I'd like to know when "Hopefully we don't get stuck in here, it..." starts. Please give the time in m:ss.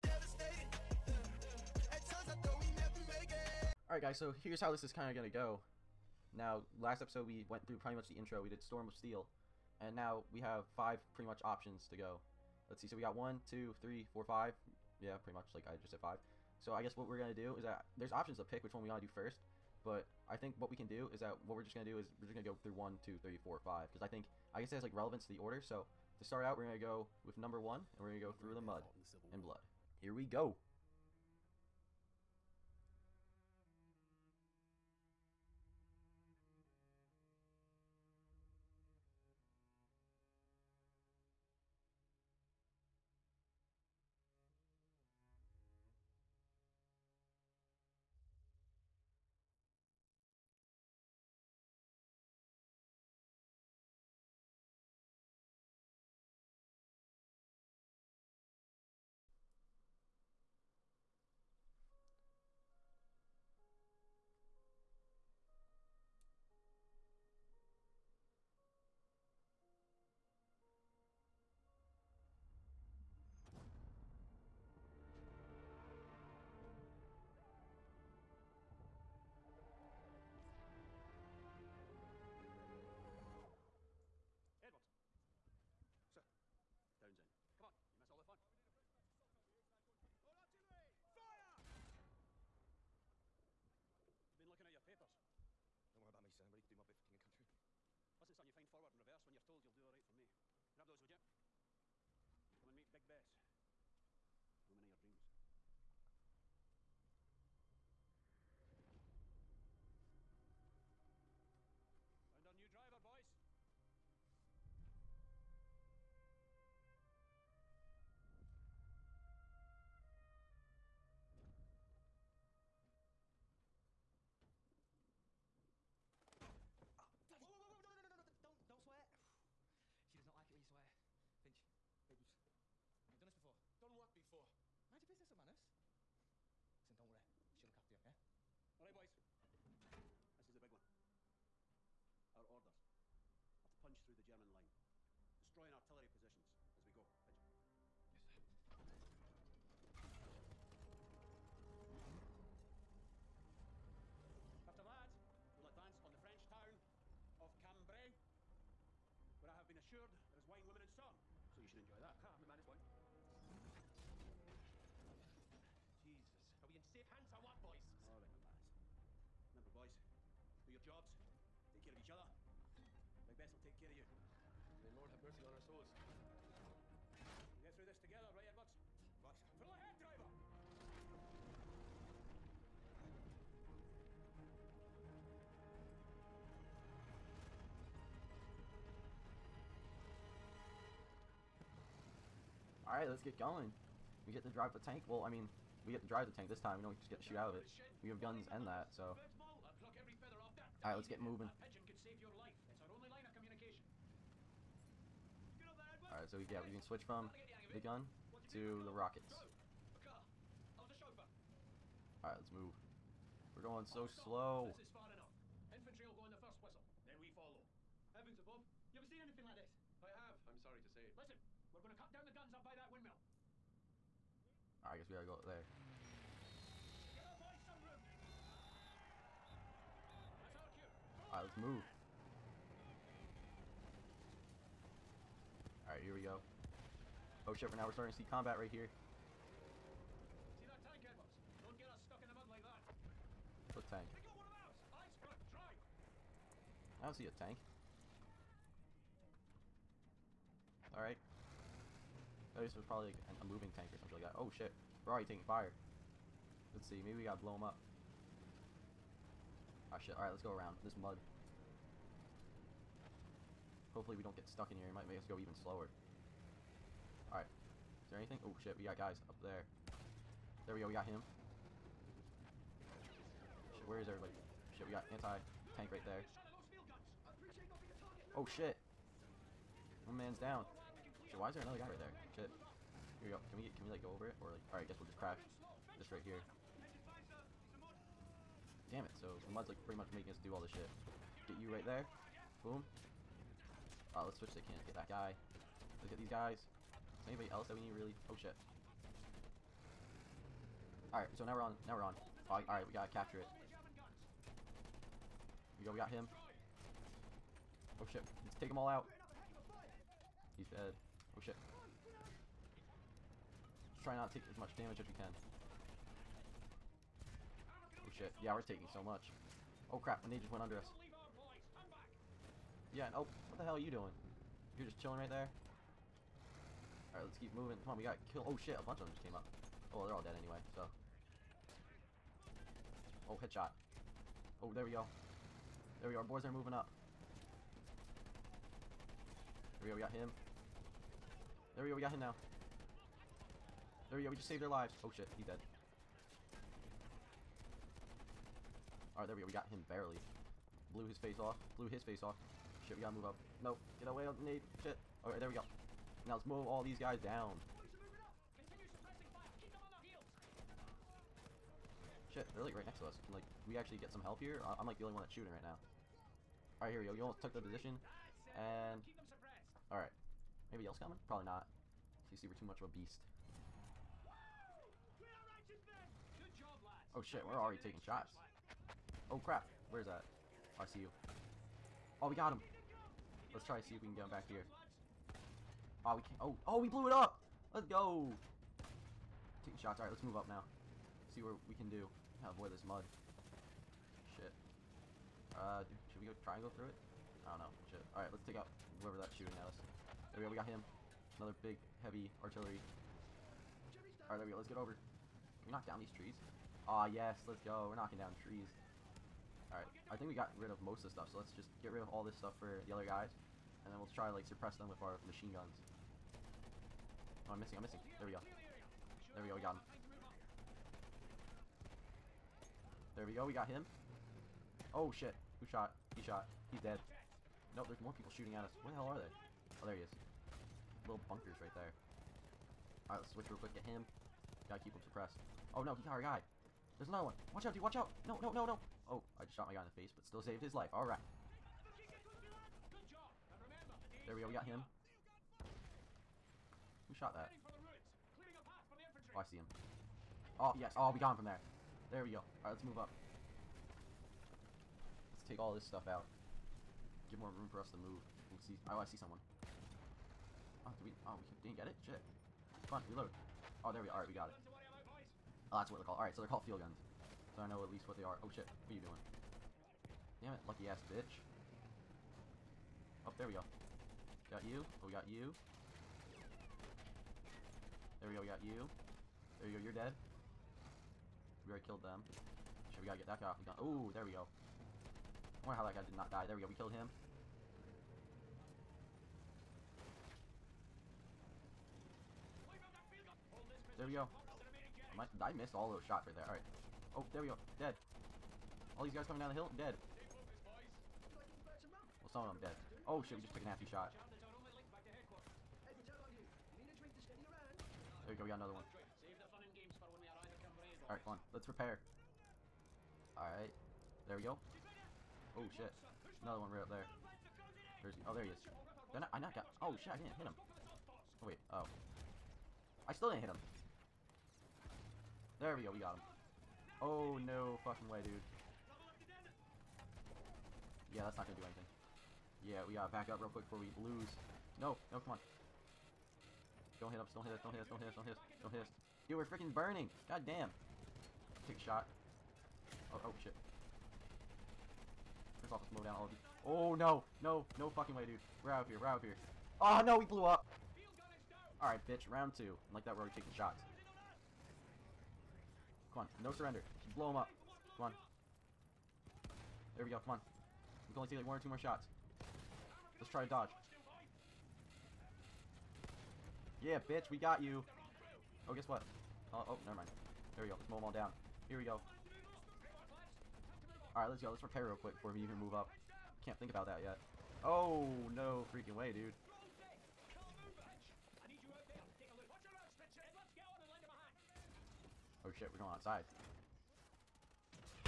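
4:23.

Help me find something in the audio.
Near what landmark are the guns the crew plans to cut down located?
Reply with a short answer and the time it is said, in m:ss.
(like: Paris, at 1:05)
windmill, at 3:42.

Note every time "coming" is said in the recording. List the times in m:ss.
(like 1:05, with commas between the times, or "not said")
6:10, 8:19.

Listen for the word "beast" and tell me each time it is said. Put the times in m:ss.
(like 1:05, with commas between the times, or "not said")
6:12.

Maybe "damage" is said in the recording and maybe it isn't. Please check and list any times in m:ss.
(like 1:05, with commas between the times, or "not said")
5:14.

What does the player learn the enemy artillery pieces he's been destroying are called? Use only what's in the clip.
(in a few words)
field guns.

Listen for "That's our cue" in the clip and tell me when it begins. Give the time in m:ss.
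3:50.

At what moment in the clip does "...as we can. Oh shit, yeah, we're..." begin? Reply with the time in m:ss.
5:14.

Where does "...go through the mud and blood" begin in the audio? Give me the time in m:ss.
0:28.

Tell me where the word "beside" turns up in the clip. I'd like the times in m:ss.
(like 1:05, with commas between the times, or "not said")
not said.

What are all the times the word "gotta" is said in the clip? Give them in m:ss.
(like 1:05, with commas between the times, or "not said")
3:45, 4:17, 5:02, 5:53, 6:32, 7:14, 8:03, 8:52.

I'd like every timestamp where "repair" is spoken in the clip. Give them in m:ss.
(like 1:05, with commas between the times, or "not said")
8:31, 9:34.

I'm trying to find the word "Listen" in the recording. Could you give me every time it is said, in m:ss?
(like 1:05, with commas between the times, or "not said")
1:38, 2:16, 3:41.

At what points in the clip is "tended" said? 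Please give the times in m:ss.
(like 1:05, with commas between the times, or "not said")
not said.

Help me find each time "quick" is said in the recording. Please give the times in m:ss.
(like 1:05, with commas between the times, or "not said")
7:13, 8:53, 9:34.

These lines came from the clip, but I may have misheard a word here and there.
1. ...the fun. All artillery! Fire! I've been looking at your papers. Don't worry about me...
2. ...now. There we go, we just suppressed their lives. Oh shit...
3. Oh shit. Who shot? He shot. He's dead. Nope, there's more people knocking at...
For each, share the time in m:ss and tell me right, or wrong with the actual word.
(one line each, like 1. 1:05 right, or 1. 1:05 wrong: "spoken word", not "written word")
1. 1:28 right
2. 5:42 wrong: "saved", not "suppressed"
3. 7:04 wrong: "shooting", not "knocking".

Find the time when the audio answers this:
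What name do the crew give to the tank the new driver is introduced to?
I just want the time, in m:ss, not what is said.
1:42.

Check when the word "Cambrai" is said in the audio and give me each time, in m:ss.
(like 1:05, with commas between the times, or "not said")
2:37.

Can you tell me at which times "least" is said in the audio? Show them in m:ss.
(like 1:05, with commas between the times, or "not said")
7:47.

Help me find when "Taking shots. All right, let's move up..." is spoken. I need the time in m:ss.
6:29.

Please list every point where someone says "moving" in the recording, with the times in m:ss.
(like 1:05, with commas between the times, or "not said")
3:21, 4:13, 5:27, 5:36.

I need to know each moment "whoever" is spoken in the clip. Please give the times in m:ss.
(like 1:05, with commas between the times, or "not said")
6:39.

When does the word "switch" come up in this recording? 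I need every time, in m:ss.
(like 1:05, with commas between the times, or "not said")
3:26, 4:54, 7:13.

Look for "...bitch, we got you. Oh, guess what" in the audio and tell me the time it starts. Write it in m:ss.
9:26.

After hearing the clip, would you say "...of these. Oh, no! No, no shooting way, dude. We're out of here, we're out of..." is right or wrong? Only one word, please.
wrong.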